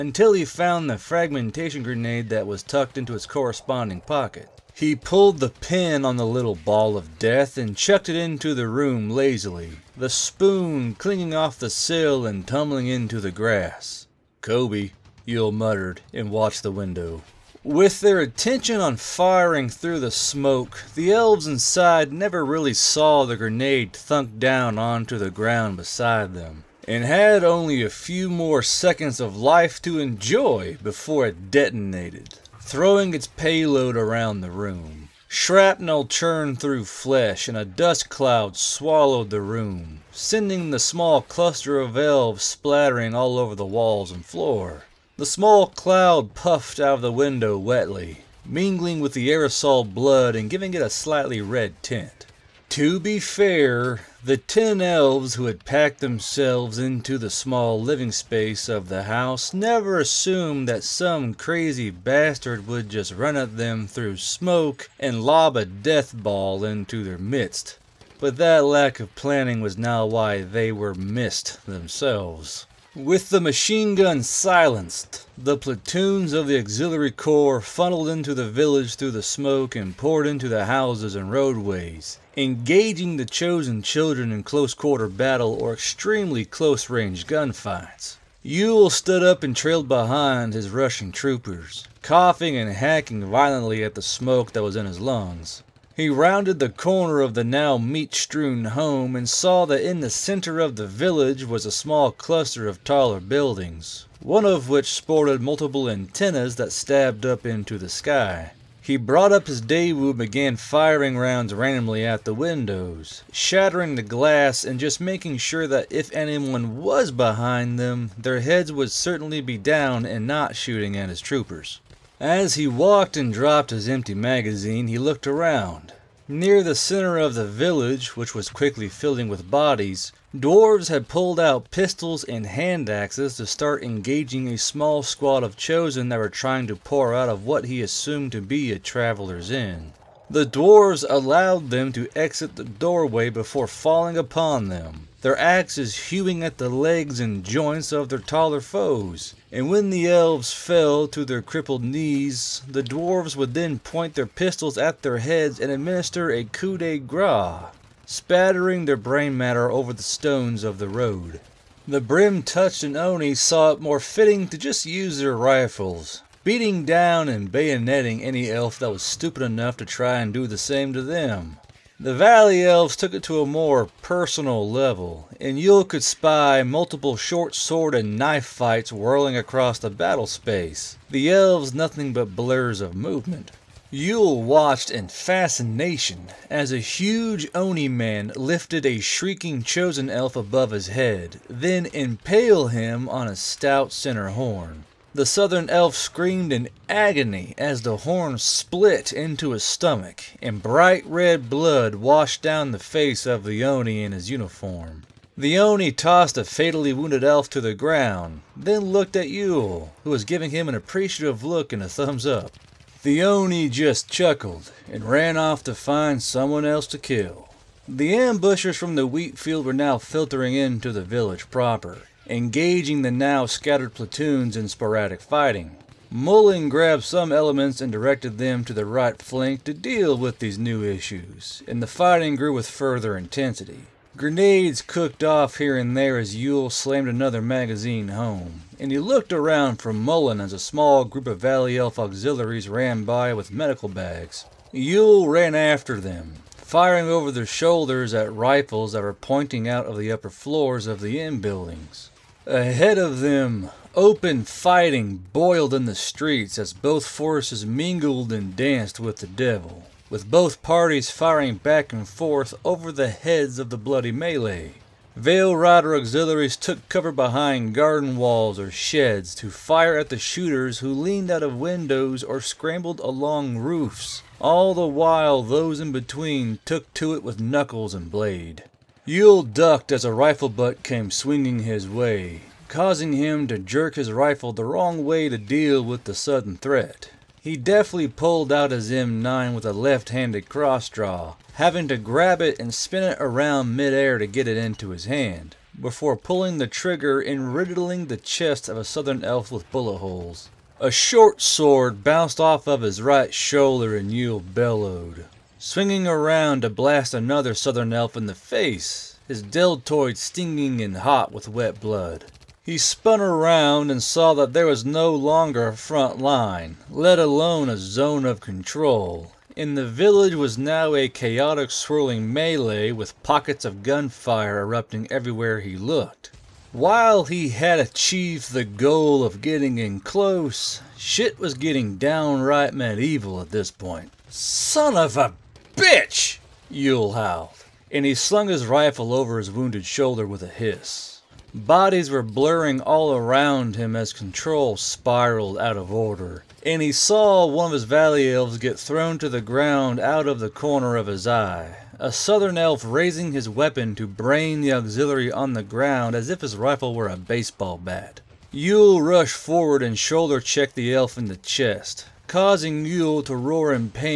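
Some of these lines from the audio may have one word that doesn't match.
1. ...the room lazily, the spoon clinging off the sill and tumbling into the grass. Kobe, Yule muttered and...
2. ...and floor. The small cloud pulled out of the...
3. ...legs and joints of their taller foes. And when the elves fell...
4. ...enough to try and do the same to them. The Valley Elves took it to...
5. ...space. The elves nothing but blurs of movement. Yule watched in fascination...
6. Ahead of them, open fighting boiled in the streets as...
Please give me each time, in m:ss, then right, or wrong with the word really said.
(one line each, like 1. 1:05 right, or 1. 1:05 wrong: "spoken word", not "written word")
1. 0:08 right
2. 0:44 wrong: "puffed", not "pulled"
3. 2:26 right
4. 2:49 right
5. 3:00 right
6. 4:12 right.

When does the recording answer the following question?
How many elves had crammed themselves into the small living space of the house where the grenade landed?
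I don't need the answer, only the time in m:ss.
0:54.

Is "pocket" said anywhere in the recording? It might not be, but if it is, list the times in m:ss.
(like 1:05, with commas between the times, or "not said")
0:04, 5:23.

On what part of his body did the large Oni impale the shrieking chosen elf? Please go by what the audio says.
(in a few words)
center horn.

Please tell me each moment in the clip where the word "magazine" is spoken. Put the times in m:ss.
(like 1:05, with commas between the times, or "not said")
2:04, 3:57.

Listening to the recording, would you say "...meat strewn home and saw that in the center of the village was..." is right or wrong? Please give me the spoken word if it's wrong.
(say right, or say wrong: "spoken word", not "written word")
right.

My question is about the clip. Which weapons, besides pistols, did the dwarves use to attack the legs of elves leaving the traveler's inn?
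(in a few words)
hand axes.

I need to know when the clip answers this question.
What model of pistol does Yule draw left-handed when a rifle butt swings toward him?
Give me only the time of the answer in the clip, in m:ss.
4:48.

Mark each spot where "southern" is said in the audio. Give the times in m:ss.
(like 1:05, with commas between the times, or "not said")
3:15, 4:58, 5:07, 5:52.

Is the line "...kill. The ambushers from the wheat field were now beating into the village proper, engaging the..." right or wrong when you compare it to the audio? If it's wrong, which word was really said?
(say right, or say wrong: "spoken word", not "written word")
wrong: "filtering", not "beating".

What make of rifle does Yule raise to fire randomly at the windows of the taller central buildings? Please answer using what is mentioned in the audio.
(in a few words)
Daewoo.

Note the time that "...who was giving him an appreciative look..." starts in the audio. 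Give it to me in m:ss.
3:30.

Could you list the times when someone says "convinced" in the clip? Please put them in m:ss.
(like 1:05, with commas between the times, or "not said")
not said.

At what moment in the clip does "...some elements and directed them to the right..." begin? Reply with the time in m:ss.
3:47.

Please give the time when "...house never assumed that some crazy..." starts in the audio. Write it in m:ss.
0:59.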